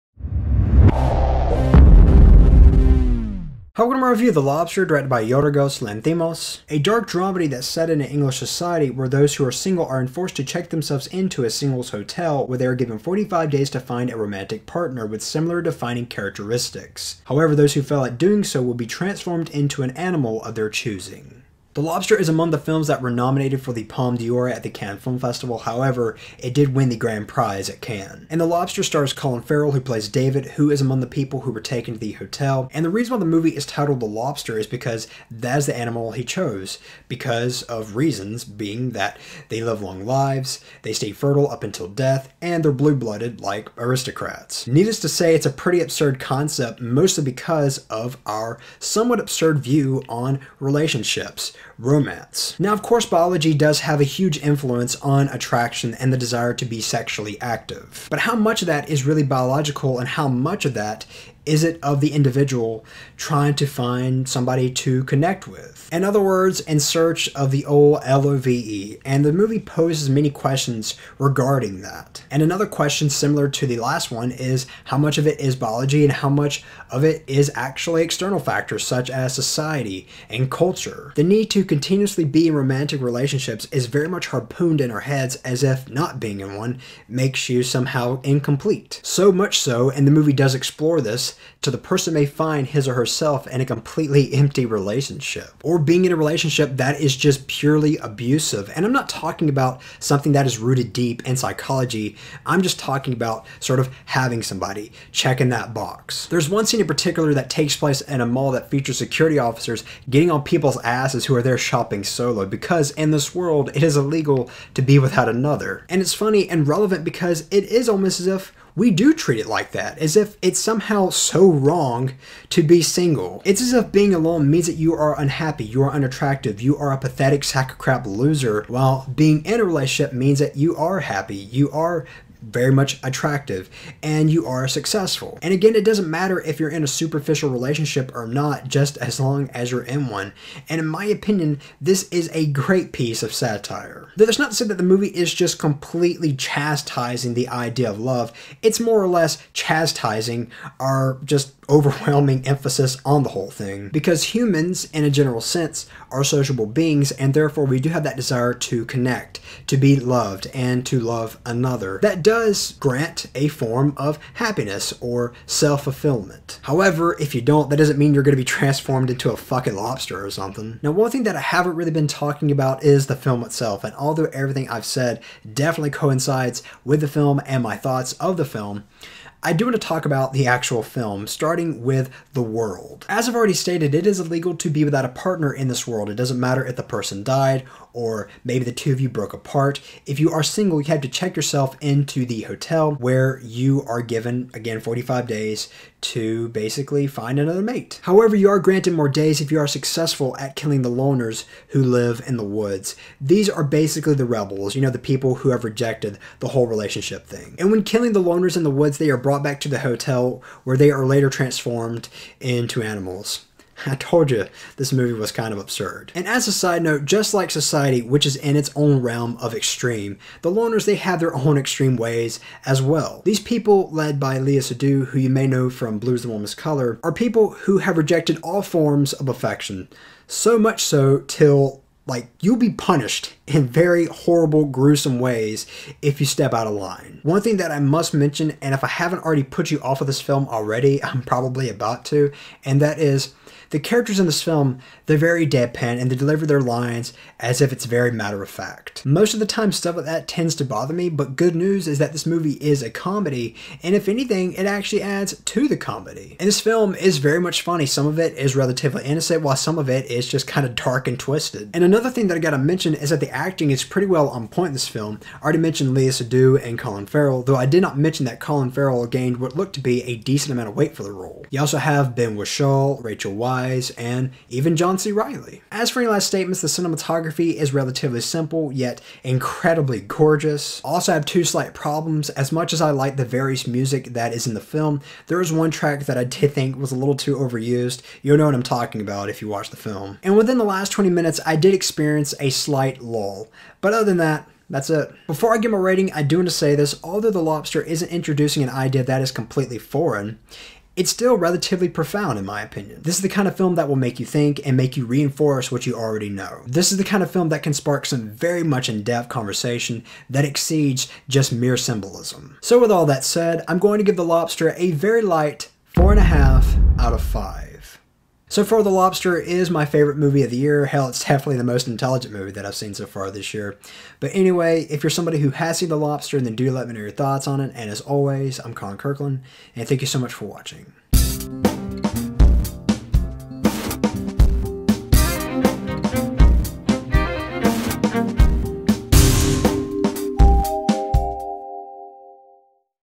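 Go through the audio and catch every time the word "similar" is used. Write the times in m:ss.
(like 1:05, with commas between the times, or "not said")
0:15, 1:13.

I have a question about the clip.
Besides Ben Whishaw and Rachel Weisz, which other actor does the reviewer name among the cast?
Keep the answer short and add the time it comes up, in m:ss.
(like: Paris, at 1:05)
John C. Reilly, at 4:34.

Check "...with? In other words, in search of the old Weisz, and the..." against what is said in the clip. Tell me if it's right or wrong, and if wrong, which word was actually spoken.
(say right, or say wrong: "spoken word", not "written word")
wrong: "LOVE", not "Weisz".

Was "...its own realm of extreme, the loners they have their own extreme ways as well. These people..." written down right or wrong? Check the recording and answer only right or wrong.
right.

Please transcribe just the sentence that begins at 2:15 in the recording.
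And again, it doesn't matter if you're in a superficial relationship or not, just as long as you're in one.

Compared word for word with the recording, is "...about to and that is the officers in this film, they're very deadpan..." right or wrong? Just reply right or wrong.
wrong.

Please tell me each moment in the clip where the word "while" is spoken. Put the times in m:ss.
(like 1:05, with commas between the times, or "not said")
2:08, 4:19.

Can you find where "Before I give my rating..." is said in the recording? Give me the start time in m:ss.
4:55.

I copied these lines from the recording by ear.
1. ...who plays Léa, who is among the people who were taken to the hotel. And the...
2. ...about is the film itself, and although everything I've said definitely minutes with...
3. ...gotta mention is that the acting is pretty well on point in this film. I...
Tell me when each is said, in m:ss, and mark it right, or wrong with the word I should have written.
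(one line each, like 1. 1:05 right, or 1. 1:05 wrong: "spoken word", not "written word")
1. 0:29 wrong: "David", not "Léa"
2. 2:52 wrong: "coincides", not "minutes"
3. 4:22 right.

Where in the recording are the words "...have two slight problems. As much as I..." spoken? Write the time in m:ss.
4:41.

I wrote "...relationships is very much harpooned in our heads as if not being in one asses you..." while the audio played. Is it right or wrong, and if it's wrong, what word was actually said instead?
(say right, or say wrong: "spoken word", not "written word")
wrong: "makes", not "asses".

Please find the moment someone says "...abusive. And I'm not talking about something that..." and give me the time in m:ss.
1:37.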